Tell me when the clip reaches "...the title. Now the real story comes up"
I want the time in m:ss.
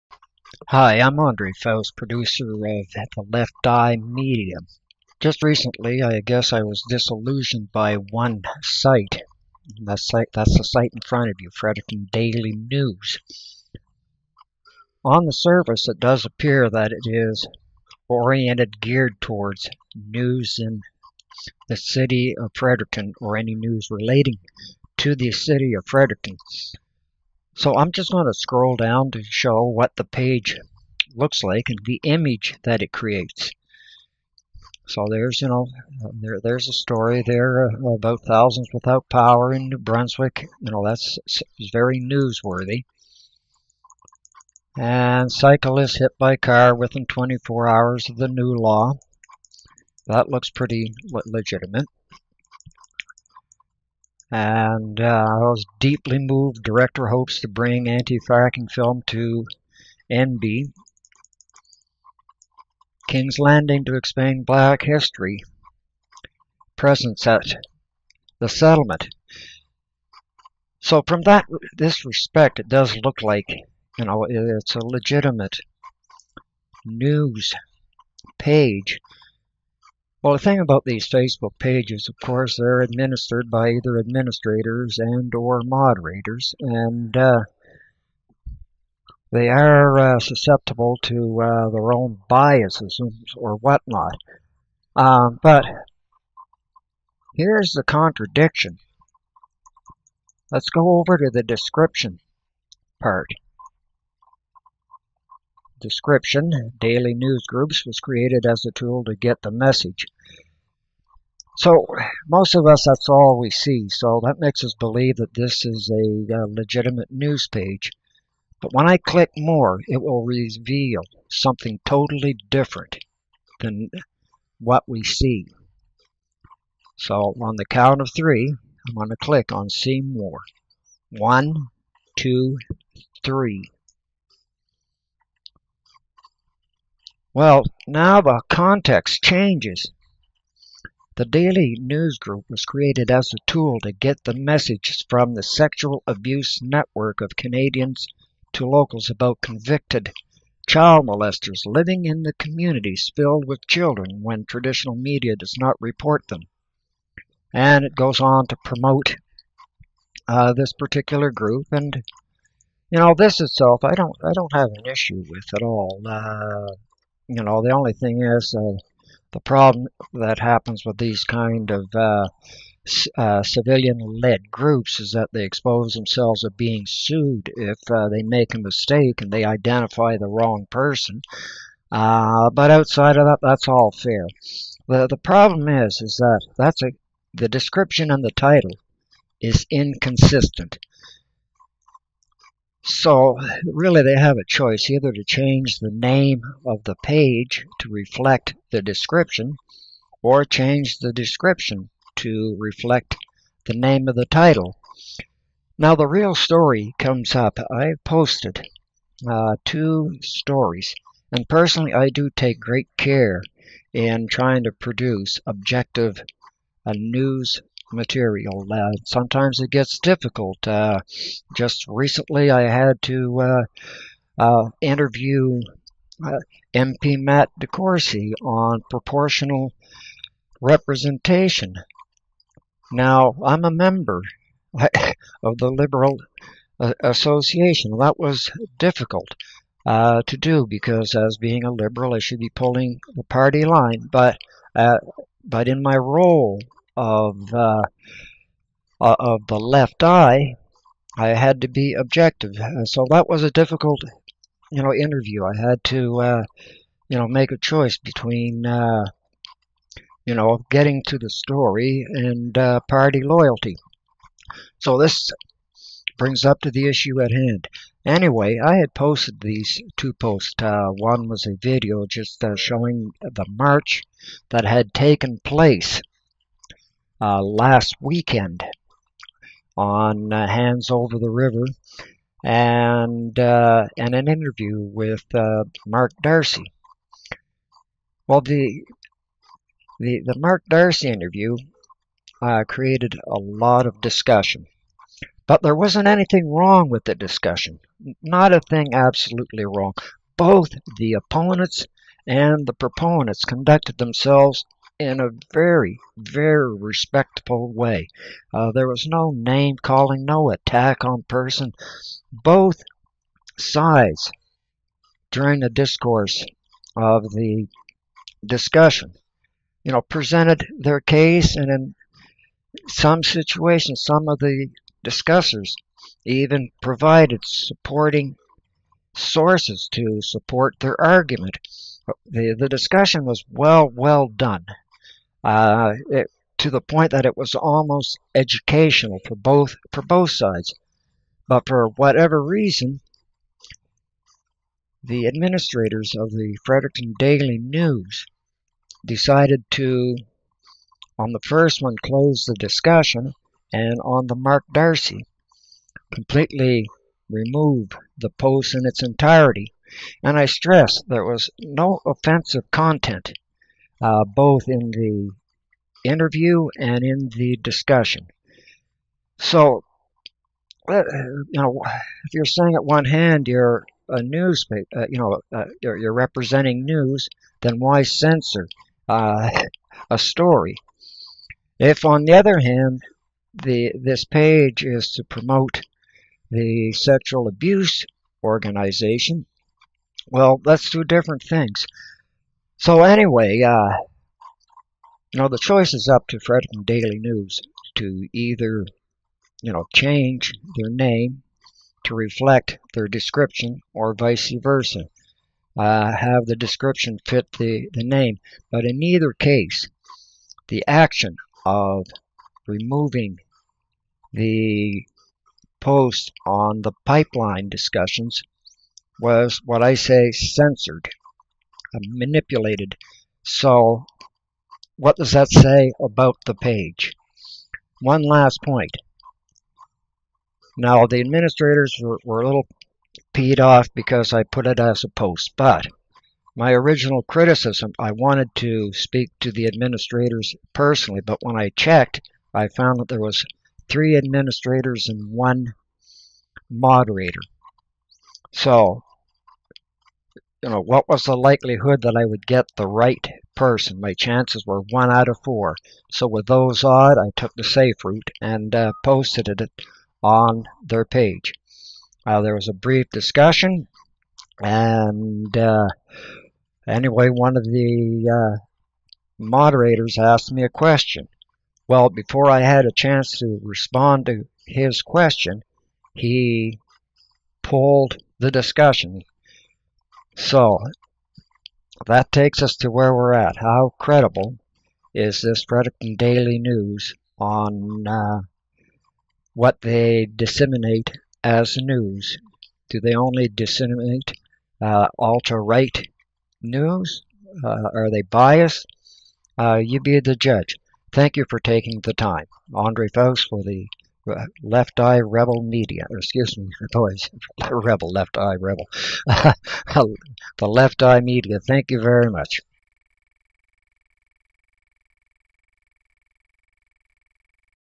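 3:24.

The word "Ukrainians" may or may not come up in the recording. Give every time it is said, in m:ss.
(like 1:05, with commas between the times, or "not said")
not said.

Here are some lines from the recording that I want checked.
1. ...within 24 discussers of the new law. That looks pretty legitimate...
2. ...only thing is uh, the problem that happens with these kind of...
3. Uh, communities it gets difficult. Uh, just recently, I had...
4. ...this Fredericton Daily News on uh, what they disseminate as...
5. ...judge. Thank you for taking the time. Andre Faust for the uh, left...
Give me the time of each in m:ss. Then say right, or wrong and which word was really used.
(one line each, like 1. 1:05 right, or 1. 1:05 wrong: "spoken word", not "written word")
1. 0:46 wrong: "hours", not "discussers"
2. 2:47 right
3. 3:38 wrong: "sometimes", not "communities"
4. 8:05 right
5. 8:20 right.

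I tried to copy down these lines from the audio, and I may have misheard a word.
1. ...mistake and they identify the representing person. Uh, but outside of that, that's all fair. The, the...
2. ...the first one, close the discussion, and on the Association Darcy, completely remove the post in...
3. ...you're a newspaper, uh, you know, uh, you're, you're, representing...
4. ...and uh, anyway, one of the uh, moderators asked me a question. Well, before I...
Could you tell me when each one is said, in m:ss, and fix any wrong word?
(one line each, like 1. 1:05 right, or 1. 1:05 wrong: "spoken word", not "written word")
1. 2:58 wrong: "wrong", not "representing"
2. 5:51 wrong: "Mark", not "Association"
3. 6:13 right
4. 7:44 right.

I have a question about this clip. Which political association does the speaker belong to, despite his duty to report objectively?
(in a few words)
Liberal Association.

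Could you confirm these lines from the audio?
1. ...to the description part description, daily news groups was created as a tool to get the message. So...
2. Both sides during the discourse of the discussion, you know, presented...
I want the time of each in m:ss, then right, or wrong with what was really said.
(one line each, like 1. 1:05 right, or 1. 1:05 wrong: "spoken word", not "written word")
1. 1:41 right
2. 5:12 right.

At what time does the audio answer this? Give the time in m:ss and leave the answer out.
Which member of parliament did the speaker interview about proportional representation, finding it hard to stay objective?
3:47.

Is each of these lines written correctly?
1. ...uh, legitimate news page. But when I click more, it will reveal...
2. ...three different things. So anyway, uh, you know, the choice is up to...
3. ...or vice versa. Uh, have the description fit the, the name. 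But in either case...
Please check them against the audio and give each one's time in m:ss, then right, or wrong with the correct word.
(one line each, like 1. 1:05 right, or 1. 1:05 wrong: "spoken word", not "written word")
1. 1:56 right
2. 6:30 wrong: "two", not "three"
3. 6:43 right.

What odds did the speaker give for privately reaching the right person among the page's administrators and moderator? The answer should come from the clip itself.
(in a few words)
one out of four.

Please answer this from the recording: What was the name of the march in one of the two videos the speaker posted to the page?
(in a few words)
Hands Over the River.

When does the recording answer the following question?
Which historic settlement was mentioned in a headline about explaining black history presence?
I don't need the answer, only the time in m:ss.
1:03.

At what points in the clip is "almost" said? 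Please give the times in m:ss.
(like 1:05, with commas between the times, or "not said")
5:37.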